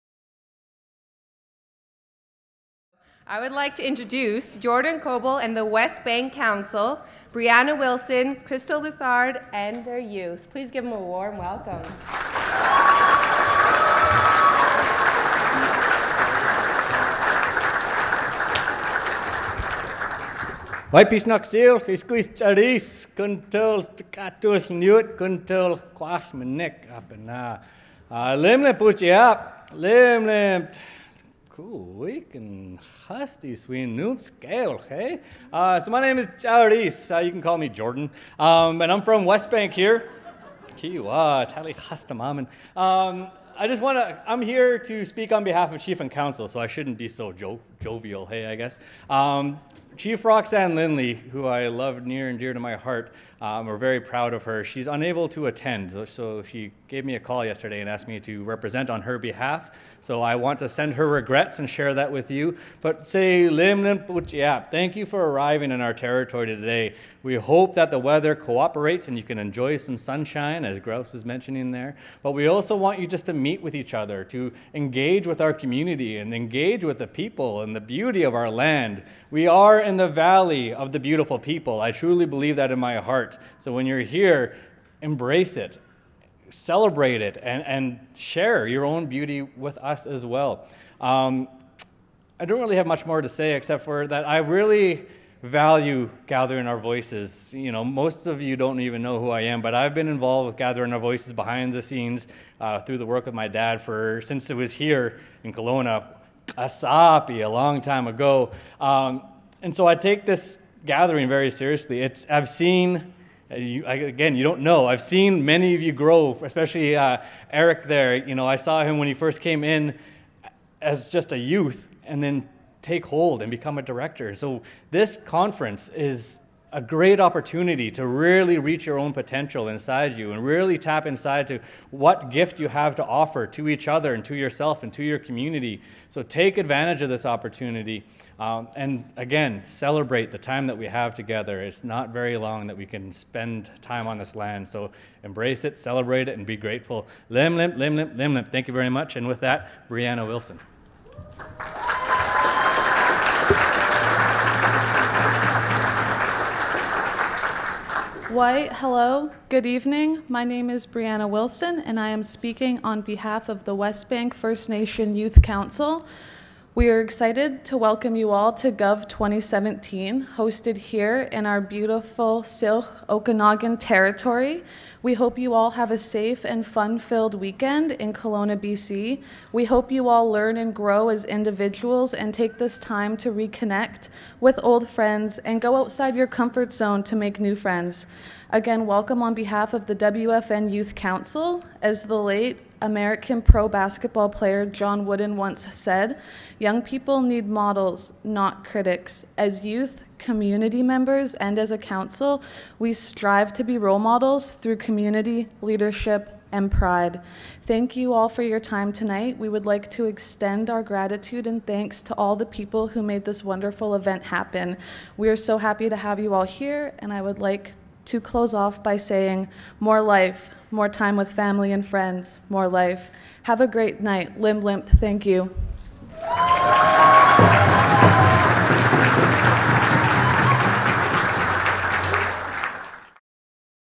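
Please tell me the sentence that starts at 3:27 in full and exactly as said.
Thank you all for your time tonight.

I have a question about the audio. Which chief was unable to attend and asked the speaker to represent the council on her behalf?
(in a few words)
Roxanne Lindley.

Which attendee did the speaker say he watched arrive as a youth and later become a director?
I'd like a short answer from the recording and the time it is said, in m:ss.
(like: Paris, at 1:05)
Eric, at 1:57.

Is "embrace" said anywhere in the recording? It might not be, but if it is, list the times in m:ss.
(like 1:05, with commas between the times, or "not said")
1:25, 2:25.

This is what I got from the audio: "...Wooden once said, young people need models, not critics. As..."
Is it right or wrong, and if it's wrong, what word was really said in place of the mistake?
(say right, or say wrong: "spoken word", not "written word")
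right.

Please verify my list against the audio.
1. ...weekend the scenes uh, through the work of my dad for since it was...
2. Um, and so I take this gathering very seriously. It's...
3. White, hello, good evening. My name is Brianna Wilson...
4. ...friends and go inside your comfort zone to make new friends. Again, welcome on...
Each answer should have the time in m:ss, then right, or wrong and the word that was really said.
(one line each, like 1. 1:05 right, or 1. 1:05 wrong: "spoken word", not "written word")
1. 1:41 wrong: "behind", not "weekend"
2. 1:48 right
3. 2:38 right
4. 3:04 wrong: "outside", not "inside".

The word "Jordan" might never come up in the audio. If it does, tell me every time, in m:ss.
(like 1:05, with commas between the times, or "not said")
0:04, 0:37.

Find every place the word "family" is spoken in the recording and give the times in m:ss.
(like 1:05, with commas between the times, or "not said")
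3:41.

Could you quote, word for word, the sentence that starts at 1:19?
We are in the valley of the beautiful people.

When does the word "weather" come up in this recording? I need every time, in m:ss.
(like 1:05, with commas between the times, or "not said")
1:07.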